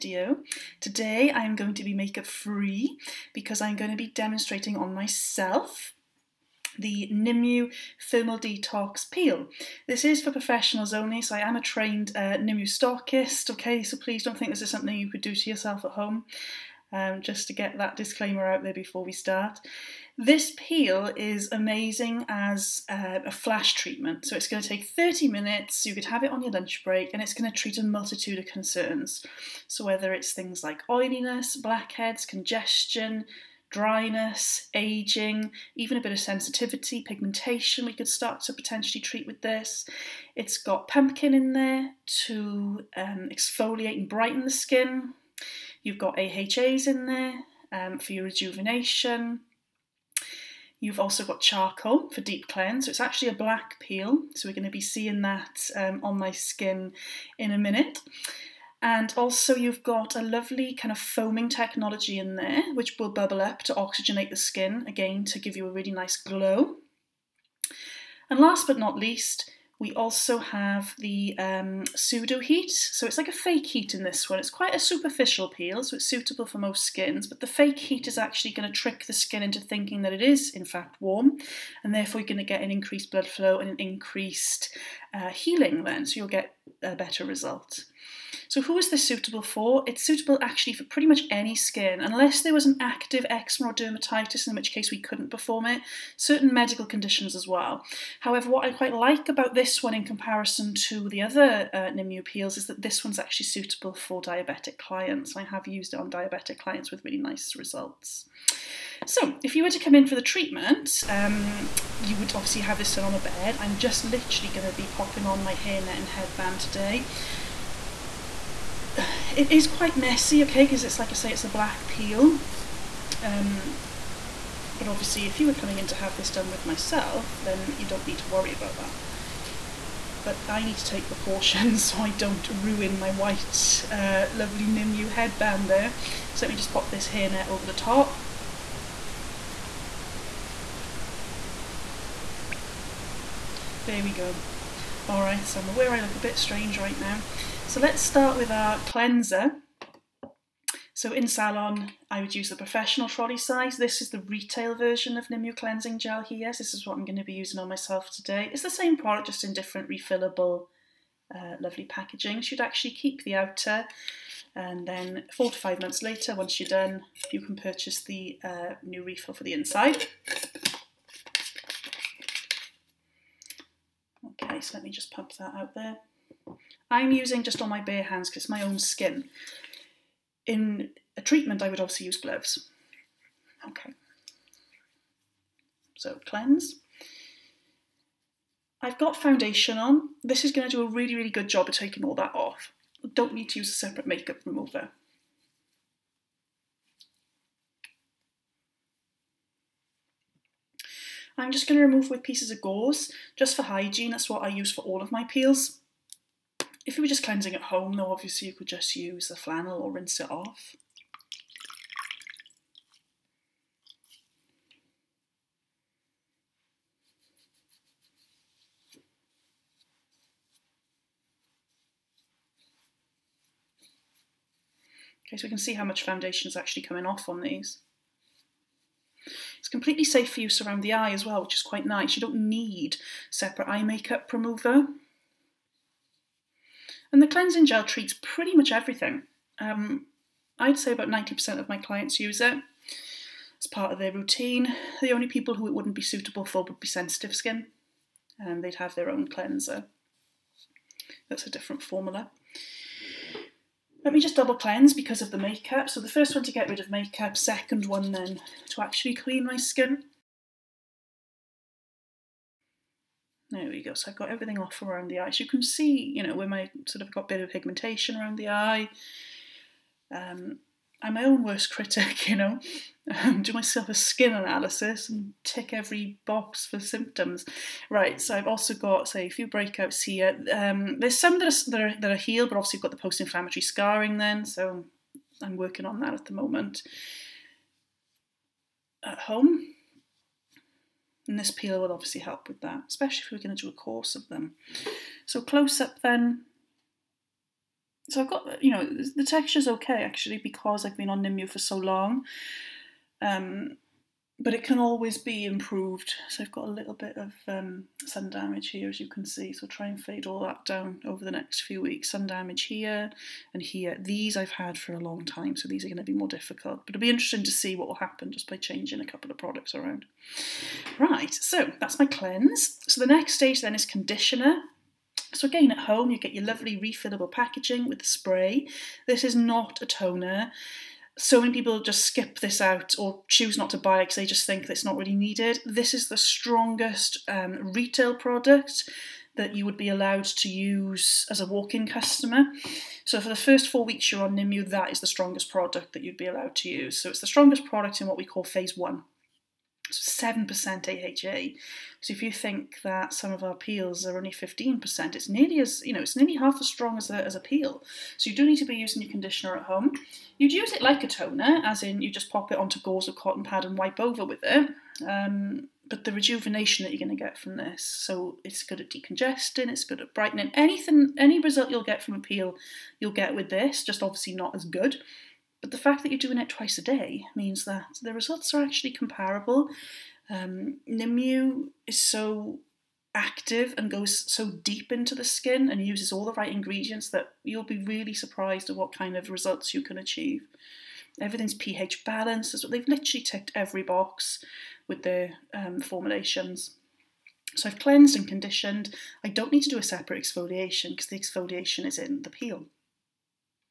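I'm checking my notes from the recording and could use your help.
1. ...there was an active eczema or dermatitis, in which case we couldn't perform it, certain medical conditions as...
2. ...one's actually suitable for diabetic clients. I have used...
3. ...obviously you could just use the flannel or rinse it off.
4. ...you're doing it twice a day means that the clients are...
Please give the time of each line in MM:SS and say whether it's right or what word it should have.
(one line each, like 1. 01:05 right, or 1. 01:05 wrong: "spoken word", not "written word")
1. 01:32 right
2. 01:43 right
3. 03:28 right
4. 06:16 wrong: "results", not "clients".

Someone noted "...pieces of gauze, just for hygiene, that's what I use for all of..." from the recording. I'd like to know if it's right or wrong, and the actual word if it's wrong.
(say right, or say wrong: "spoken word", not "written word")
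right.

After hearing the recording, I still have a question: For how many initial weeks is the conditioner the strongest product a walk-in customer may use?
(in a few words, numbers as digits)
4 weeks.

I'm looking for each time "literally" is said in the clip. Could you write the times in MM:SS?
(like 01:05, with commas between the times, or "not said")
01:54, 06:32.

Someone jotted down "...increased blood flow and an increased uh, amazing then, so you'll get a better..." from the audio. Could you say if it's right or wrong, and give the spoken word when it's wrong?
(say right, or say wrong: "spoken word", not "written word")
wrong: "healing", not "amazing".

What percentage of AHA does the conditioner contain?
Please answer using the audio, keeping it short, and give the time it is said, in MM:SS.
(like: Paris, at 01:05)
7%, at 05:49.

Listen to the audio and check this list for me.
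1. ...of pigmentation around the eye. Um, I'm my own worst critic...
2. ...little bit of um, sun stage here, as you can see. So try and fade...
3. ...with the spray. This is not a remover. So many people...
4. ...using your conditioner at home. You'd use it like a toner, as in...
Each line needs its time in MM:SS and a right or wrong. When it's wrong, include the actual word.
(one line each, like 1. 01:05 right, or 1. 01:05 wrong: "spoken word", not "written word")
1. 04:27 right
2. 05:06 wrong: "damage", not "stage"
3. 05:27 wrong: "toner", not "remover"
4. 05:58 right.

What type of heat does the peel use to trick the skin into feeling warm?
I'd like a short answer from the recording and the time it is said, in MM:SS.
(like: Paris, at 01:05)
Pseudo heat, at 01:11.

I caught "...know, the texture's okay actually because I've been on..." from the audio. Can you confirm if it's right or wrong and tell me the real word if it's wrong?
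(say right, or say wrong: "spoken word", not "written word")
right.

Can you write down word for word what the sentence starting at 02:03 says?
Um, but obviously, if you were coming in to have this done with myself, then you don't need to worry about that.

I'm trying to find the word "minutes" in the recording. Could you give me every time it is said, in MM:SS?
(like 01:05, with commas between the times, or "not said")
00:25, 00:57.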